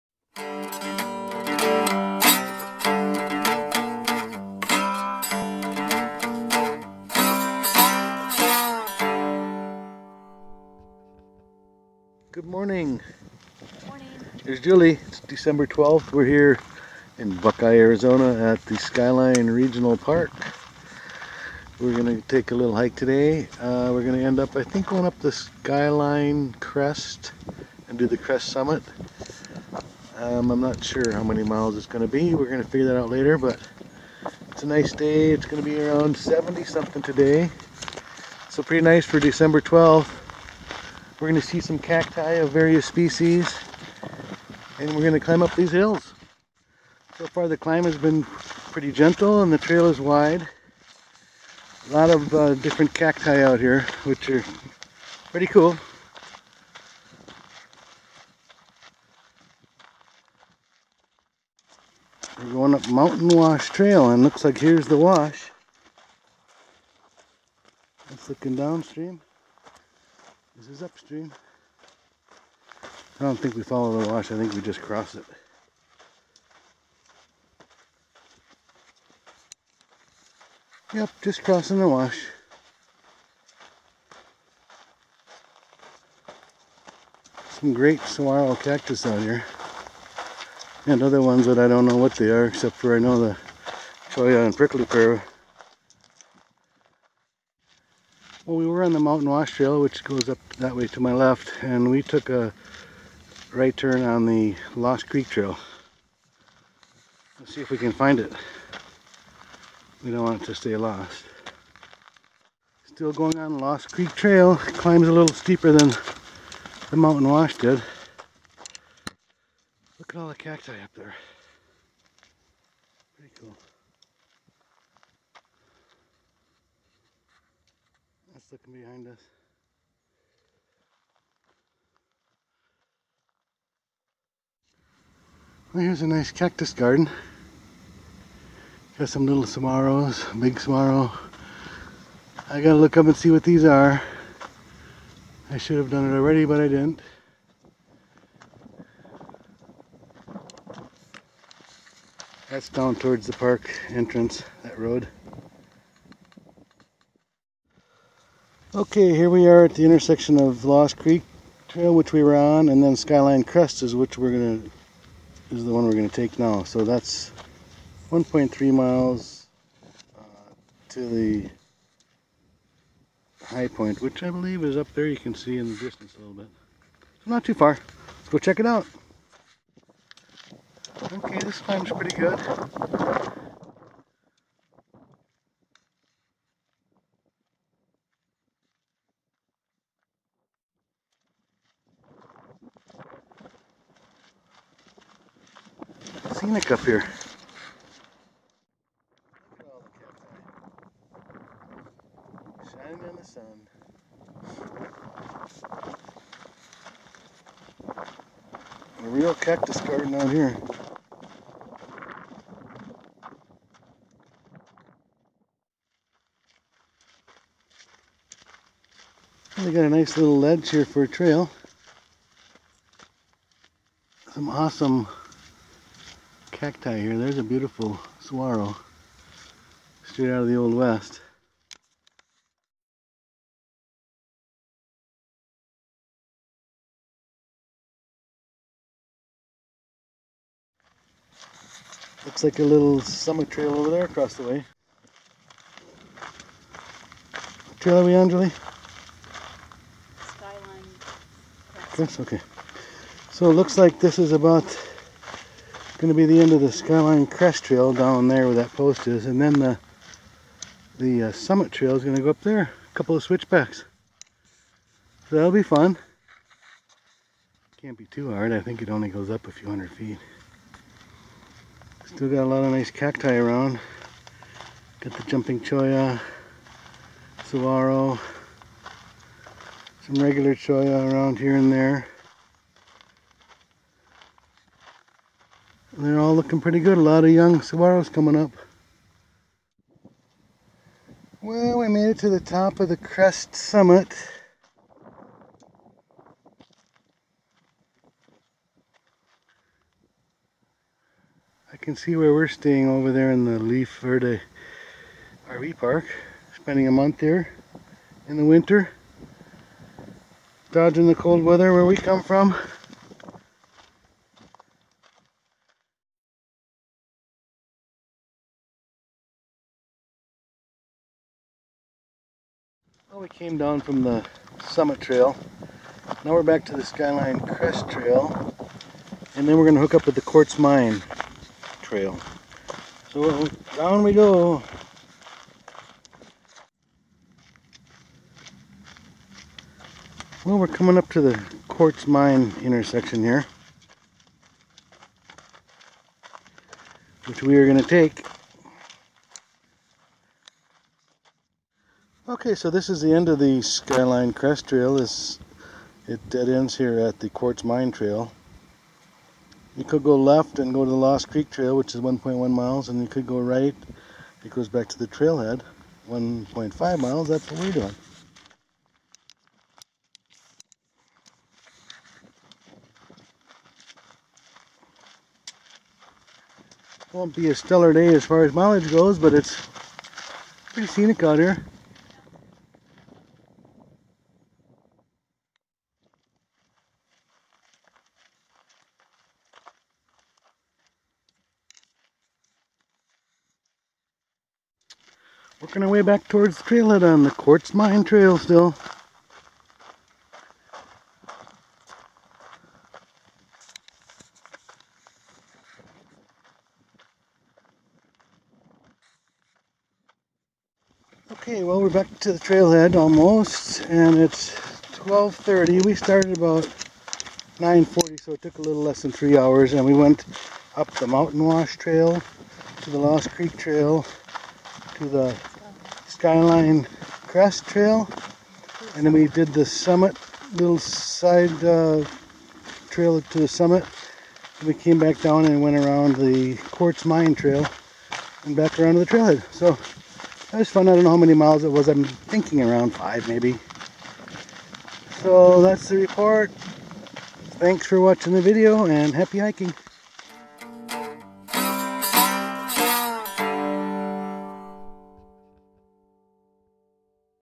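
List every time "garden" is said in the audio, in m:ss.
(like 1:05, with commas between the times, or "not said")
2:16, 3:29.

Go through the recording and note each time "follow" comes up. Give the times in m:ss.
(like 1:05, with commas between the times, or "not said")
1:13.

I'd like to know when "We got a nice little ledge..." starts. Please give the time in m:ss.
3:39.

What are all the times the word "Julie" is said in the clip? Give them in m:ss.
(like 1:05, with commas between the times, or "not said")
0:14, 4:08.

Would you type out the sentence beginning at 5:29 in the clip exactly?
And then we're going to hook up with the Quartz Mine Trail.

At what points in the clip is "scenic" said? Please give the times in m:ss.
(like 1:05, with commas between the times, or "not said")
3:16, 6:20.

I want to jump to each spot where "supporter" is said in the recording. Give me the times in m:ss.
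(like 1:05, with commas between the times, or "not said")
not said.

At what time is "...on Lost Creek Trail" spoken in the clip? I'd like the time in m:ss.
1:53.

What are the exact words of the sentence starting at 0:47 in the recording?
So far the climb has been pretty gentle and the trail is wide.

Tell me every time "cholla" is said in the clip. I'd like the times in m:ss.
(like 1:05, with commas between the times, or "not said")
1:34, 4:35, 4:40.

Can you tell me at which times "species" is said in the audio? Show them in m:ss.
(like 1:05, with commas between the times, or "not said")
0:42.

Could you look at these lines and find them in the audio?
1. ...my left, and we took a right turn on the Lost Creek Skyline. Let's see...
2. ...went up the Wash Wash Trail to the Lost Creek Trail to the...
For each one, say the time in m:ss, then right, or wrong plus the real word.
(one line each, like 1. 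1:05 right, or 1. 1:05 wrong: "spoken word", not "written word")
1. 1:40 wrong: "Trail", not "Skyline"
2. 6:59 wrong: "Mountain", not "Wash".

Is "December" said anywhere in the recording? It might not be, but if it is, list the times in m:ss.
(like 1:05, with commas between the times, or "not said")
0:15, 0:39.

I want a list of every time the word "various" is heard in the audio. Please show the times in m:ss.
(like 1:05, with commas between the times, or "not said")
0:42.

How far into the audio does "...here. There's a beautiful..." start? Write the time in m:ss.
3:47.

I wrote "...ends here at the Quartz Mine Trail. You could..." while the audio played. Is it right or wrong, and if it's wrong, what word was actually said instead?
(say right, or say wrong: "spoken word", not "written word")
right.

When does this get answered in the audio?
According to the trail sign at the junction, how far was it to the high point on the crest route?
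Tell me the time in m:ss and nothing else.
2:48.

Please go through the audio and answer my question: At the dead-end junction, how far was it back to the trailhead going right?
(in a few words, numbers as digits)
1.5 miles.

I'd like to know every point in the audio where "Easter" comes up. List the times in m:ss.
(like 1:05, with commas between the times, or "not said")
not said.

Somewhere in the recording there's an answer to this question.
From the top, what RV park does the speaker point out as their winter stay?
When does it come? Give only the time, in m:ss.
5:03.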